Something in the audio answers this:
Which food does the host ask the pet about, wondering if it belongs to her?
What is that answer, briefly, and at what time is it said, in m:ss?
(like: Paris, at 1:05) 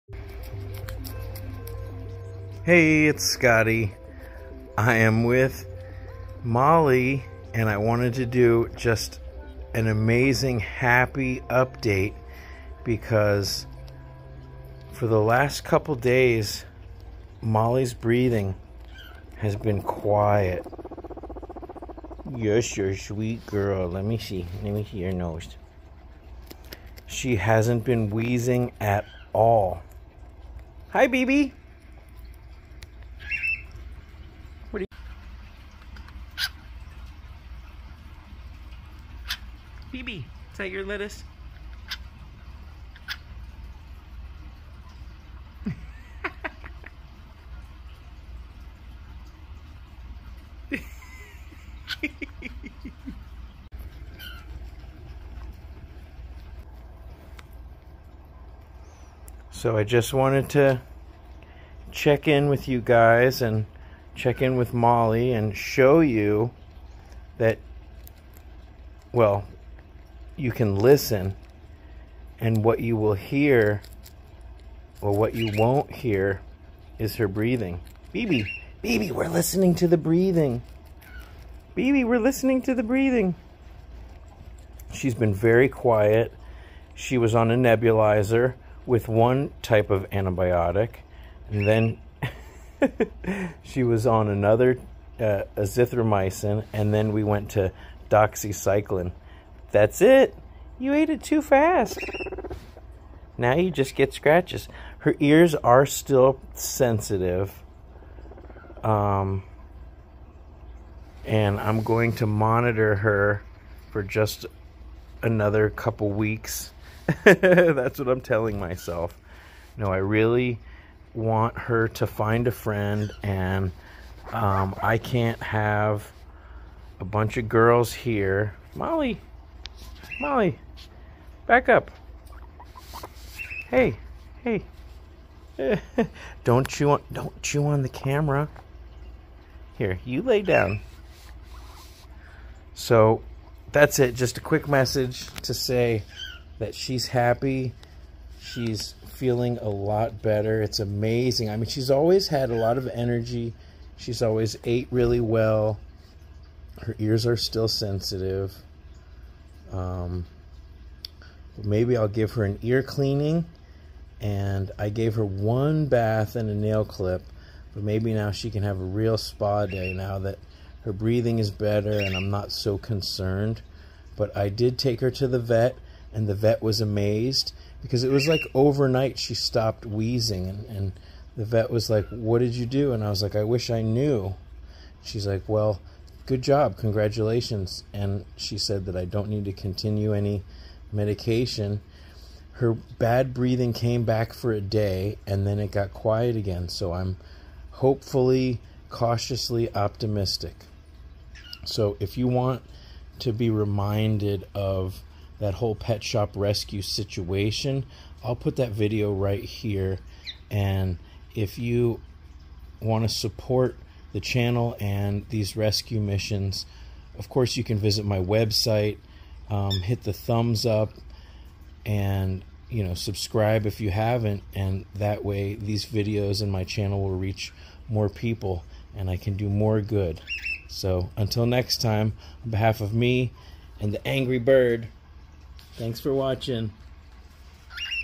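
lettuce, at 0:40.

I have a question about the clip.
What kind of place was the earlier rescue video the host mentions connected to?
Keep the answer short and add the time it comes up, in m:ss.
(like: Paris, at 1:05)
pet shop, at 3:25.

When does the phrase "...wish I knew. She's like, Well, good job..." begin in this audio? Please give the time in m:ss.
3:03.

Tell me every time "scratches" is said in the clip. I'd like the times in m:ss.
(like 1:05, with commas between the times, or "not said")
1:44.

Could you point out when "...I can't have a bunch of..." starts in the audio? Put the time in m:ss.
2:04.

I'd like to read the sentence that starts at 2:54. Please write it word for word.
But I did take her to the vet, and the vet was amazed because it was like overnight she stopped wheezing.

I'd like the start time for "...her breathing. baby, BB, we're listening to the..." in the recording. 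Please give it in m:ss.
1:17.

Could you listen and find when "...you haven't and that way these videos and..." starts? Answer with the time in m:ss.
3:43.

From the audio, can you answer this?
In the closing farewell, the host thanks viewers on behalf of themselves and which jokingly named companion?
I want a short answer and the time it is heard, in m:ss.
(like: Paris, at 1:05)
the angry bird, at 3:54.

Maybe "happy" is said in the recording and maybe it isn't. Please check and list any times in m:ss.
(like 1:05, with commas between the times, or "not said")
0:10, 2:27.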